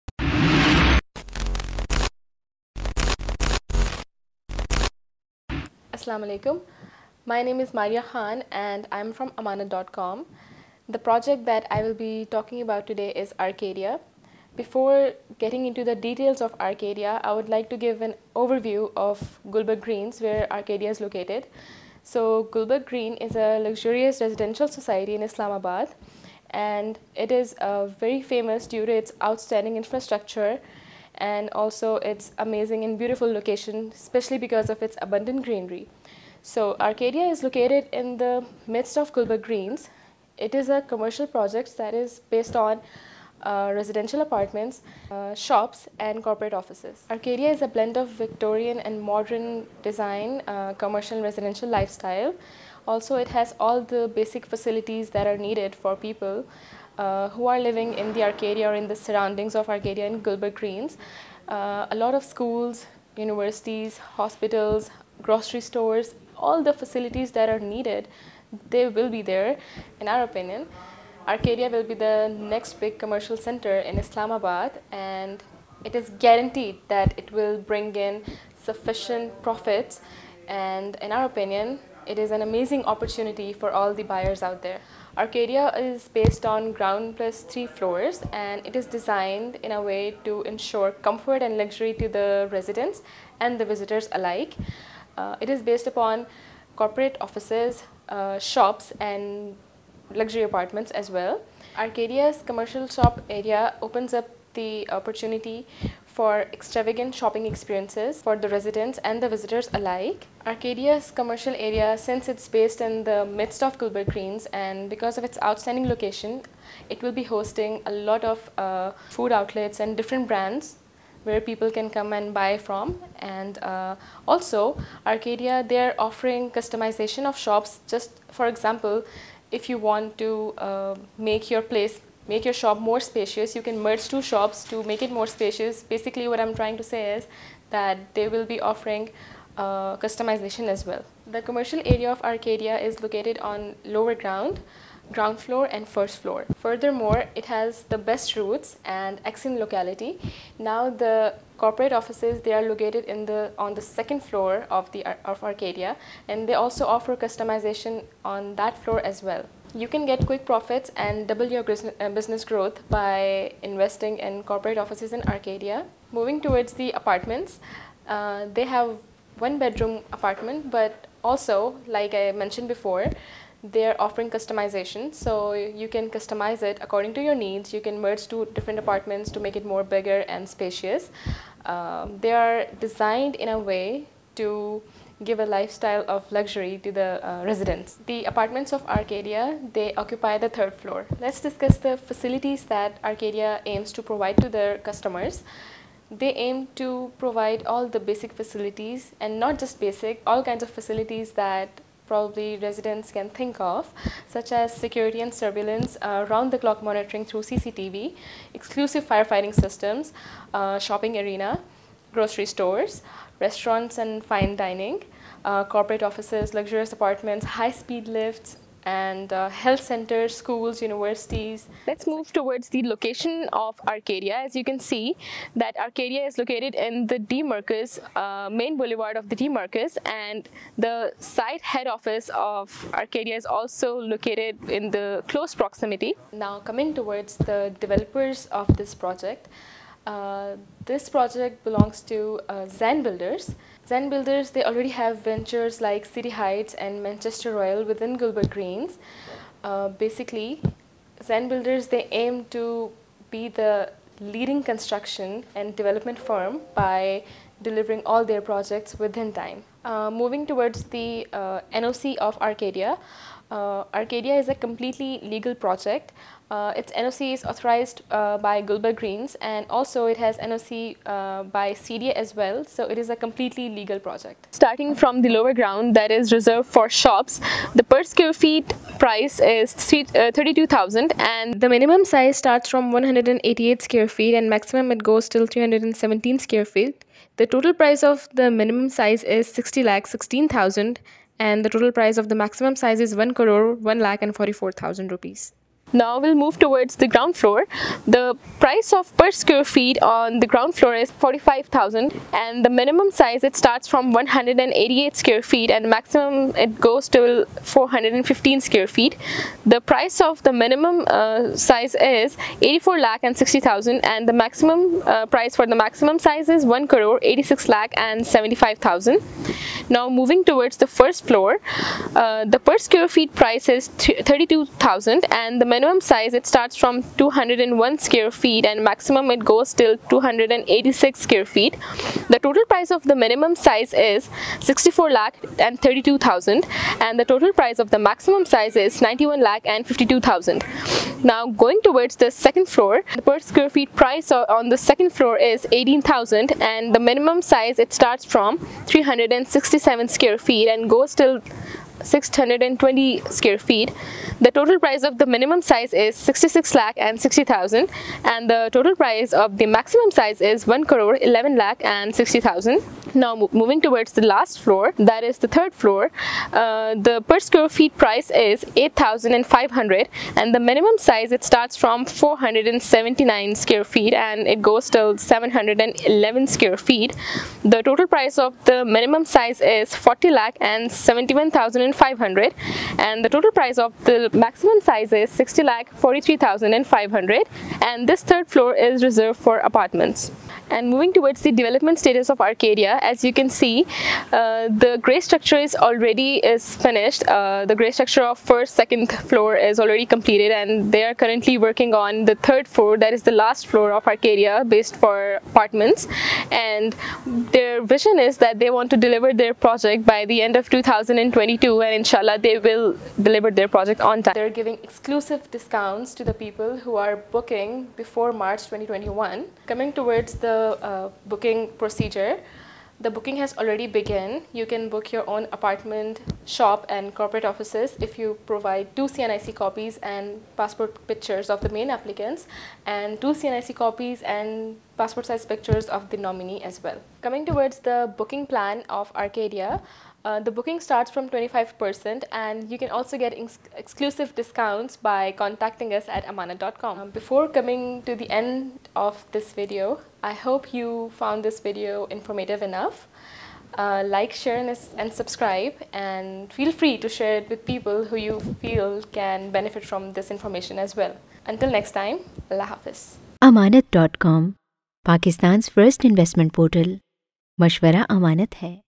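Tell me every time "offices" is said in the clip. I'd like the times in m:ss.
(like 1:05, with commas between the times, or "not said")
0:46, 1:37, 2:31, 2:44, 3:36, 3:51, 7:07.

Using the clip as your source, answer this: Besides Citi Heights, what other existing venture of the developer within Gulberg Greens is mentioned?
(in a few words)
Manchester Royal.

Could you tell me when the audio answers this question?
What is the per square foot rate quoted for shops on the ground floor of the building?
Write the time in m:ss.
5:01.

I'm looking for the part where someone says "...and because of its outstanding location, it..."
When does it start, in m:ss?
1:54.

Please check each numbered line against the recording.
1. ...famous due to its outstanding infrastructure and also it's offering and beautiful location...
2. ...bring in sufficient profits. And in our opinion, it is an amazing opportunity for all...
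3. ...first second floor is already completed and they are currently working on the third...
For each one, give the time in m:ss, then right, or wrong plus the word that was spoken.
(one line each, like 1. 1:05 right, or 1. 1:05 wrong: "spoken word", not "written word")
1. 0:28 wrong: "amazing", not "offering"
2. 1:17 right
3. 6:38 right.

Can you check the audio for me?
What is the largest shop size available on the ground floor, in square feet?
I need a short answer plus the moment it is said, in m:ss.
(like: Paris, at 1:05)
415 square feet, at 5:07.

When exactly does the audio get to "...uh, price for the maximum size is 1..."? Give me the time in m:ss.
5:15.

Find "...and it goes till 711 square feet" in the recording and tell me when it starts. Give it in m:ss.
6:14.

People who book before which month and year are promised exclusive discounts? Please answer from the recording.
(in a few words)
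March 2021.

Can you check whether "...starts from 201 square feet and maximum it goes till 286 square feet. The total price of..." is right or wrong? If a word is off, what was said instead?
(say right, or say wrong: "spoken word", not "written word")
right.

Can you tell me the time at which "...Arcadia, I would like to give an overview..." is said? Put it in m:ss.
0:16.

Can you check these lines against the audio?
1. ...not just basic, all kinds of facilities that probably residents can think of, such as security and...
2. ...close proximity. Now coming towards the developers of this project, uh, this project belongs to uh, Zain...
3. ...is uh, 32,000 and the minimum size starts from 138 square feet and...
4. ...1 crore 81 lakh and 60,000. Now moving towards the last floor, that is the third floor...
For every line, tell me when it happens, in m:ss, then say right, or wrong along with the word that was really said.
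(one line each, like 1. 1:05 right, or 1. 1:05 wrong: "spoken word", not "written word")
1. 3:19 right
2. 3:55 right
3. 4:39 wrong: "188", not "138"
4. 6:00 wrong: "11", not "81".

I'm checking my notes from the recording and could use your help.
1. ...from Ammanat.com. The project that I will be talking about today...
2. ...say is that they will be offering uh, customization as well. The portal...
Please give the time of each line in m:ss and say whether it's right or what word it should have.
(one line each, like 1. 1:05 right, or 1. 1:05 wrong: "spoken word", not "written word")
1. 0:09 right
2. 2:16 wrong: "commercial", not "portal".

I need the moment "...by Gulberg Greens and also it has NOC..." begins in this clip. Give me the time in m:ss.
4:28.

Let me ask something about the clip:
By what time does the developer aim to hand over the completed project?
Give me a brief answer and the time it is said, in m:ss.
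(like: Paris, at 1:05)
end of 2022, at 6:50.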